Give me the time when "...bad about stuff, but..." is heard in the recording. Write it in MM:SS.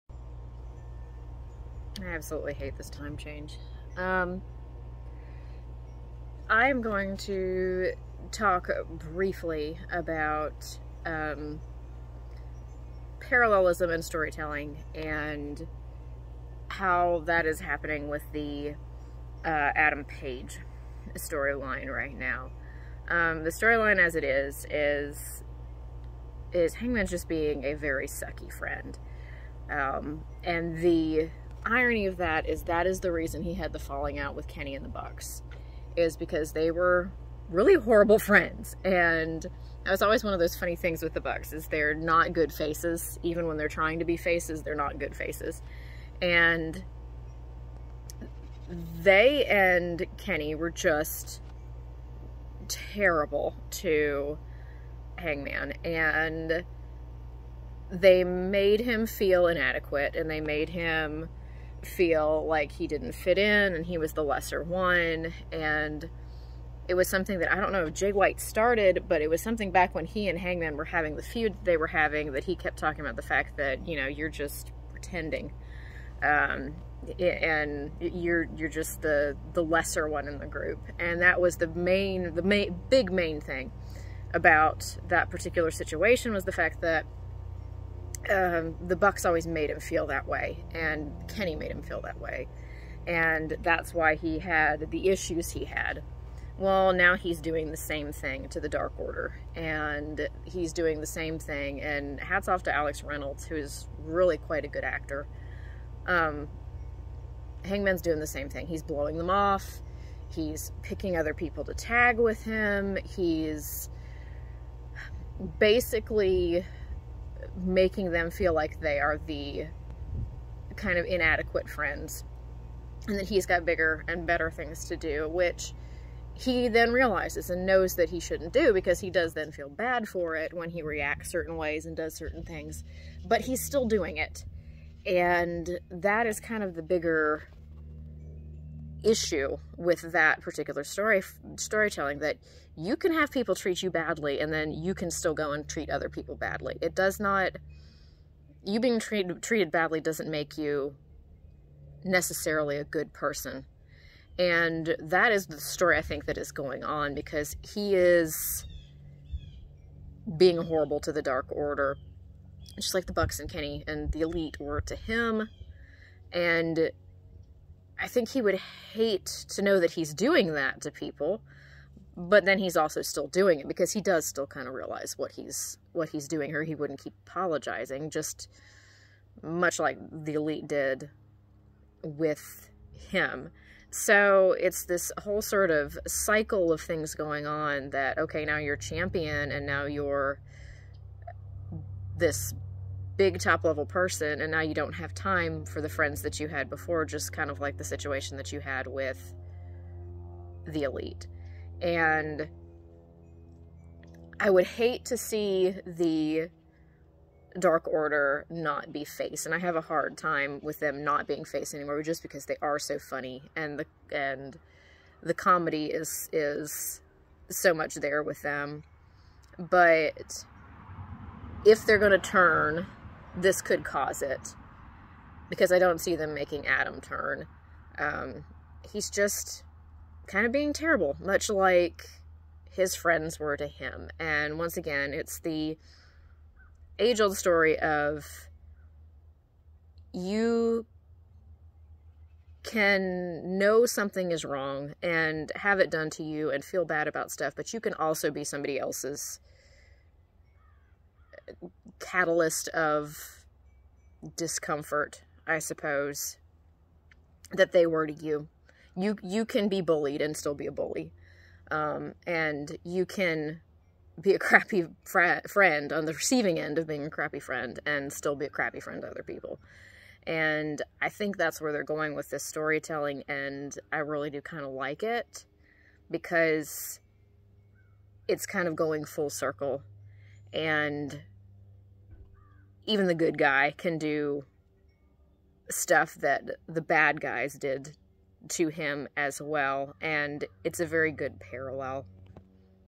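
04:06.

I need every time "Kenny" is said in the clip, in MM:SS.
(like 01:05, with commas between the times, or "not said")
00:34, 00:50, 01:31, 02:43.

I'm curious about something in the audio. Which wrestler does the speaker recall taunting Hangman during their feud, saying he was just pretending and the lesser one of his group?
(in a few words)
Jay White.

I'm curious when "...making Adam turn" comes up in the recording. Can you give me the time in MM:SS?
03:46.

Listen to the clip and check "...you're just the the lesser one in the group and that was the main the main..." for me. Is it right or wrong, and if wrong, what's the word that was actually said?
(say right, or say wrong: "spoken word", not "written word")
right.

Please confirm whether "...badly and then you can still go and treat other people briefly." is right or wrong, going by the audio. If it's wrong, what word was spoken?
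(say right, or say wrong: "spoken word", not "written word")
wrong: "badly", not "briefly".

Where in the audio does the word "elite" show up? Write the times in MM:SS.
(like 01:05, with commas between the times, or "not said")
02:44, 03:00, 03:20.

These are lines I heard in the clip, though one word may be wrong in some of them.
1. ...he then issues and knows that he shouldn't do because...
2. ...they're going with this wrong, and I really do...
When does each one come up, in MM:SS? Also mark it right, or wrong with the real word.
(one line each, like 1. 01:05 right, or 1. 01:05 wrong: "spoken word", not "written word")
1. 02:06 wrong: "realizes", not "issues"
2. 04:31 wrong: "storytelling", not "wrong".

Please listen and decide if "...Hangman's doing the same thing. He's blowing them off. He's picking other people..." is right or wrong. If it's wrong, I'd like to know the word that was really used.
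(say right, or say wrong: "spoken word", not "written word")
right.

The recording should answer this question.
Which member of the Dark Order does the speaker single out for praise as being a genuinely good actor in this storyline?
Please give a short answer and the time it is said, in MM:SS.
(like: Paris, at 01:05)
Alex Reynolds, at 01:42.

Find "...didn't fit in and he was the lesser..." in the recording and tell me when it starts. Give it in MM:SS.
01:02.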